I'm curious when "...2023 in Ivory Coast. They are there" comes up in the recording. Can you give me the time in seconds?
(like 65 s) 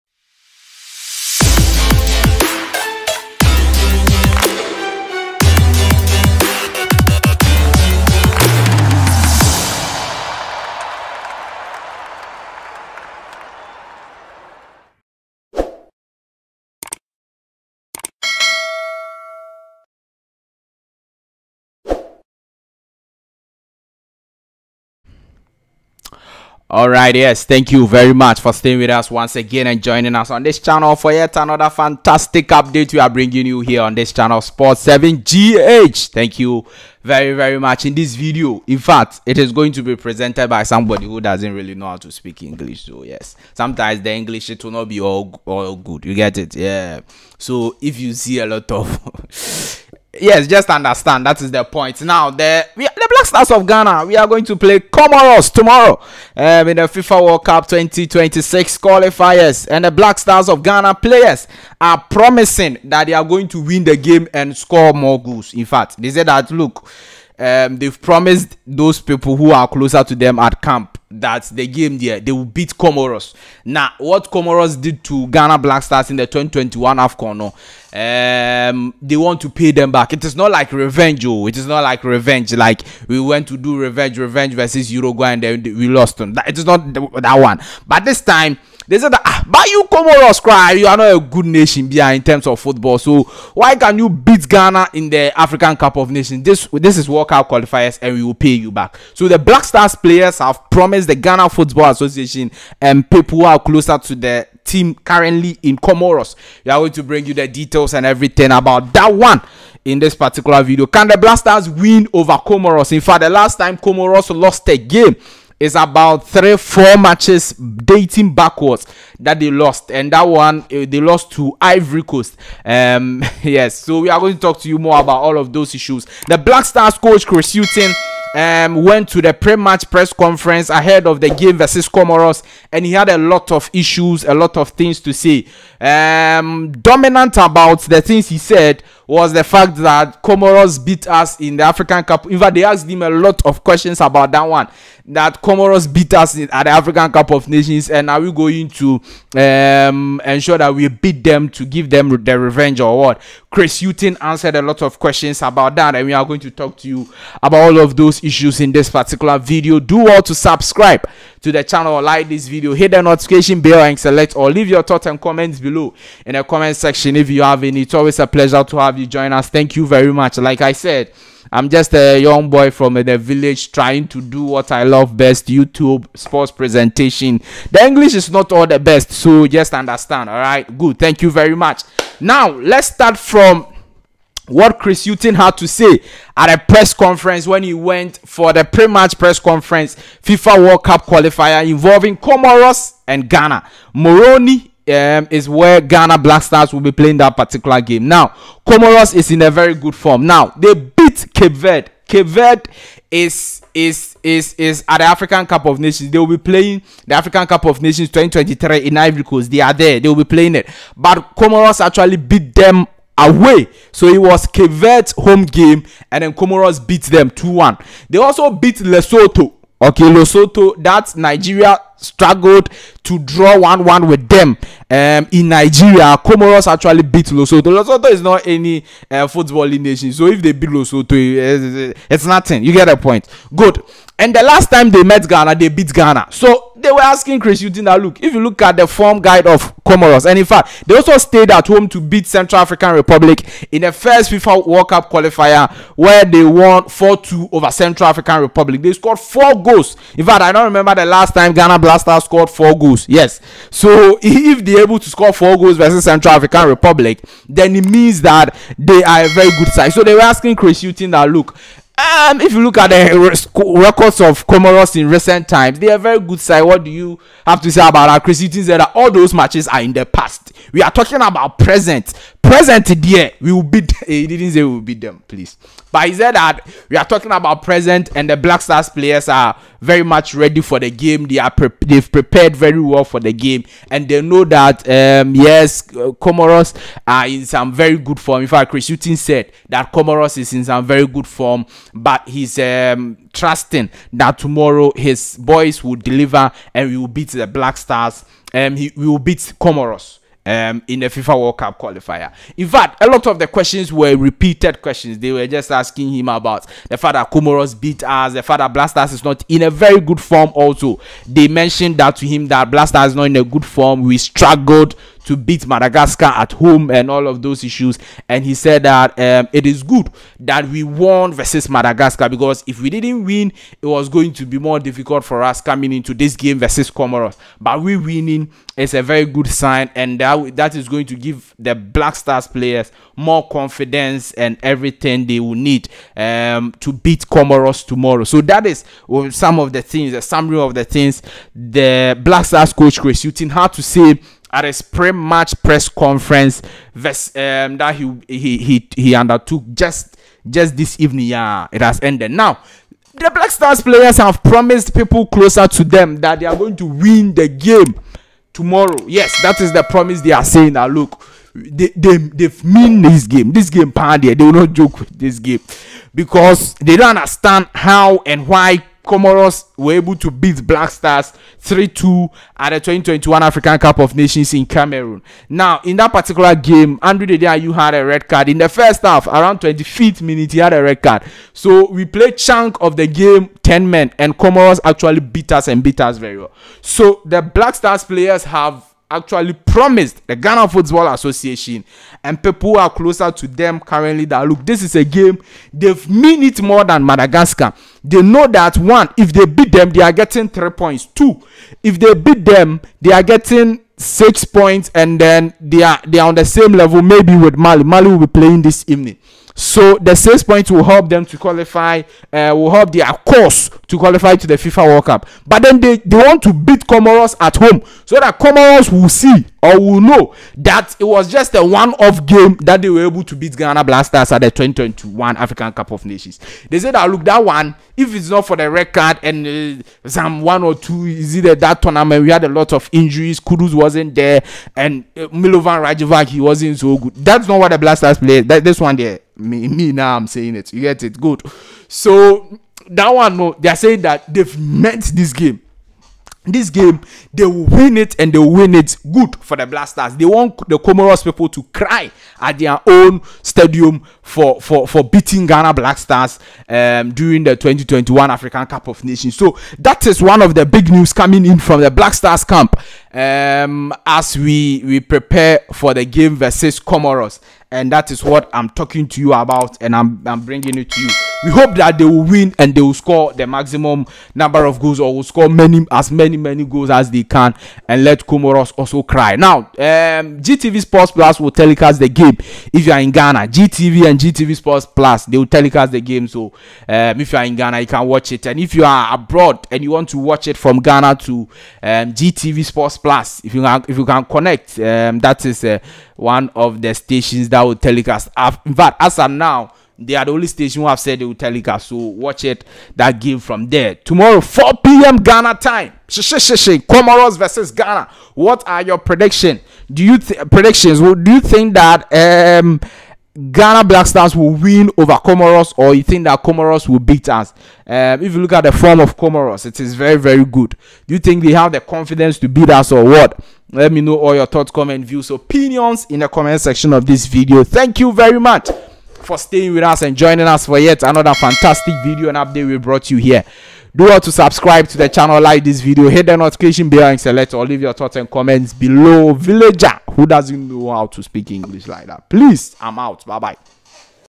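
208 s.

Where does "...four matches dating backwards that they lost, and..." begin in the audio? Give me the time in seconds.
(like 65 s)
116 s.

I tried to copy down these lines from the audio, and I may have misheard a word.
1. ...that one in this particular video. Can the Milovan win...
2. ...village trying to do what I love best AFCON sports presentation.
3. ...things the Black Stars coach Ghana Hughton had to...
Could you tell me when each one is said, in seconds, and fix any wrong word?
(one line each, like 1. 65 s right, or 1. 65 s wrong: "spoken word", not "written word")
1. 108 s wrong: "Blasters", not "Milovan"
2. 173 s wrong: "YouTube", not "AFCON"
3. 340 s wrong: "Chris", not "Ghana".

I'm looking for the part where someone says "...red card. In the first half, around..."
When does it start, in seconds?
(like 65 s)
378 s.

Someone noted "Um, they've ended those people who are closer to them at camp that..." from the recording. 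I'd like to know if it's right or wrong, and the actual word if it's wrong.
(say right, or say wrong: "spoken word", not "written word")
wrong: "promised", not "ended".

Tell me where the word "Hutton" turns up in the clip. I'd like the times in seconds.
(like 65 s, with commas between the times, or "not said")
127 s, 260 s.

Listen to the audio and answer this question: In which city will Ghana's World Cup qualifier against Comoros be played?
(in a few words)
Moroni.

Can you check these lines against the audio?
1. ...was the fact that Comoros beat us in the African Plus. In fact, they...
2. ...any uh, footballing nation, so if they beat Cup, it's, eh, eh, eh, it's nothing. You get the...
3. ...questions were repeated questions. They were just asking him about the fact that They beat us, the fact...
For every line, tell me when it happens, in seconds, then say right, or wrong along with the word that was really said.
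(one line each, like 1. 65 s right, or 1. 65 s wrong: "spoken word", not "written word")
1. 139 s wrong: "Cup", not "Plus"
2. 228 s wrong: "Lesotho", not "Cup"
3. 303 s wrong: "Comoros", not "They".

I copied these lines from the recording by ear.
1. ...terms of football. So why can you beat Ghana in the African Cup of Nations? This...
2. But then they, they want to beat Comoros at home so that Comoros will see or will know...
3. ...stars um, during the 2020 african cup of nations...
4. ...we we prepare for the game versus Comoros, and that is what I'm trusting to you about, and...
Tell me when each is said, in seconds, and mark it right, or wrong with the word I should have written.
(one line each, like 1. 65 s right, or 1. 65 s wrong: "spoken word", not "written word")
1. 92 s right
2. 415 s right
3. 455 s wrong: "2021", not "2020"
4. 464 s wrong: "talking", not "trusting".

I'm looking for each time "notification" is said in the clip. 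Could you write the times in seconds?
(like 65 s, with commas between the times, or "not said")
163 s, 536 s.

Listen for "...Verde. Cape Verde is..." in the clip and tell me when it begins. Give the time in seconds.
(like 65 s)
201 s.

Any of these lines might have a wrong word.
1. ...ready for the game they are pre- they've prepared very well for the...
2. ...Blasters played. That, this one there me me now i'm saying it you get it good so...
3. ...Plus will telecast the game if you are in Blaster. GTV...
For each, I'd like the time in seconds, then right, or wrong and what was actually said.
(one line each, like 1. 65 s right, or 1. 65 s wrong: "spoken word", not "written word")
1. 280 s right
2. 437 s right
3. 481 s wrong: "Ghana", not "Blaster".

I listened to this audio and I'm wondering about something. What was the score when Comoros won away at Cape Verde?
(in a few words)
2-1.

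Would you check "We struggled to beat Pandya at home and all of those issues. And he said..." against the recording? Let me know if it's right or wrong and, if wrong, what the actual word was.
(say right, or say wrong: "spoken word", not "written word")
wrong: "Madagascar", not "Pandya".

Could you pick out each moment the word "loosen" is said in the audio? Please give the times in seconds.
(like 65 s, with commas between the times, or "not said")
not said.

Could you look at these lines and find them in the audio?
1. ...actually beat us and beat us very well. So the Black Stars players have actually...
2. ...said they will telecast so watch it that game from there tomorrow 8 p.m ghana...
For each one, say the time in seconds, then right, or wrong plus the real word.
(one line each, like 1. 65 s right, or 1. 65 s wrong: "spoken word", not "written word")
1. 384 s right
2. 500 s wrong: "4", not "8".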